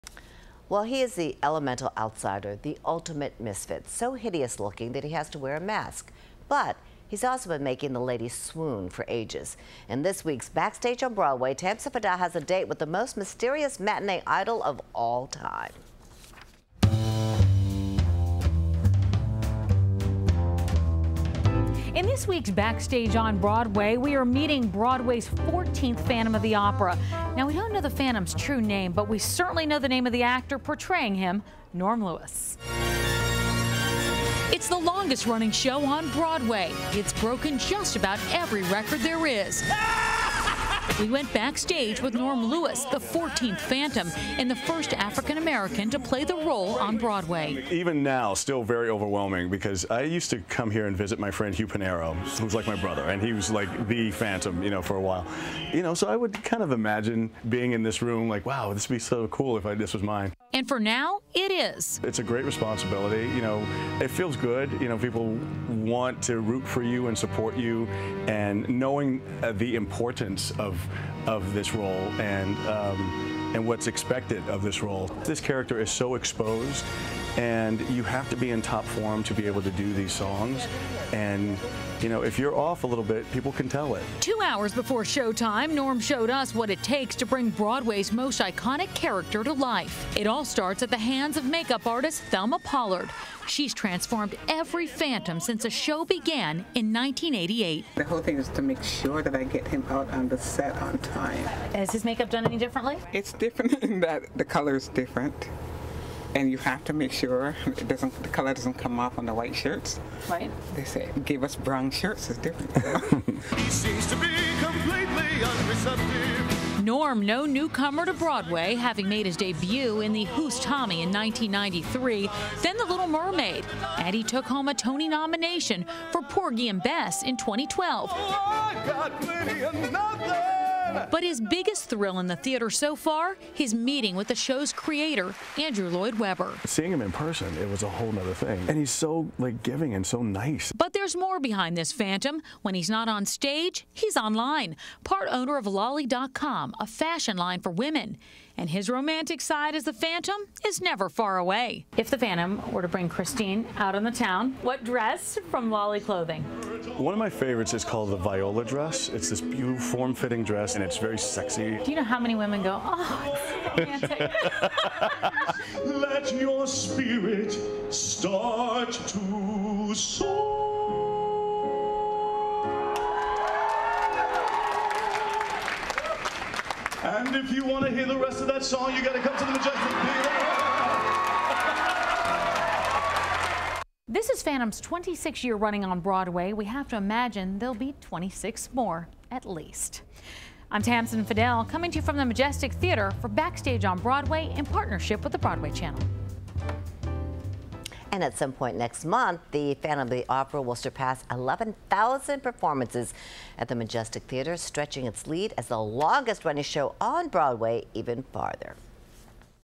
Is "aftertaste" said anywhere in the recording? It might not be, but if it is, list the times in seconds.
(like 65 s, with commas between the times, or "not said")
not said.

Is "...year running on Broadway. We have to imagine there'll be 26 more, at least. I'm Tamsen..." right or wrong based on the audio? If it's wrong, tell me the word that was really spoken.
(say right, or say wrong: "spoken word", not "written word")
right.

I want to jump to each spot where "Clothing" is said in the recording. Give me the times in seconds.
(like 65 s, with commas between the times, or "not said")
155 s.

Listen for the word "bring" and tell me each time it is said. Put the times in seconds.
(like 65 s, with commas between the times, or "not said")
87 s, 152 s.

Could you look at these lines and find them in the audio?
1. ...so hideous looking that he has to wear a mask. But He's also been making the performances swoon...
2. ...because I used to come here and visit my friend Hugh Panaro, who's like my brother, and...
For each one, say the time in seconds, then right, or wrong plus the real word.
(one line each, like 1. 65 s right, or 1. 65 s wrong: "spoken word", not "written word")
1. 3 s wrong: "ladies", not "performances"
2. 49 s right.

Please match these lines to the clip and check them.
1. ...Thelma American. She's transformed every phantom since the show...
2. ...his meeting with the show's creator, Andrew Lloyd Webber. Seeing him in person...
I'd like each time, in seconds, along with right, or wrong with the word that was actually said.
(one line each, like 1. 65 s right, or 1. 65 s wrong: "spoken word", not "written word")
1. 92 s wrong: "Pollard", not "American"
2. 133 s right.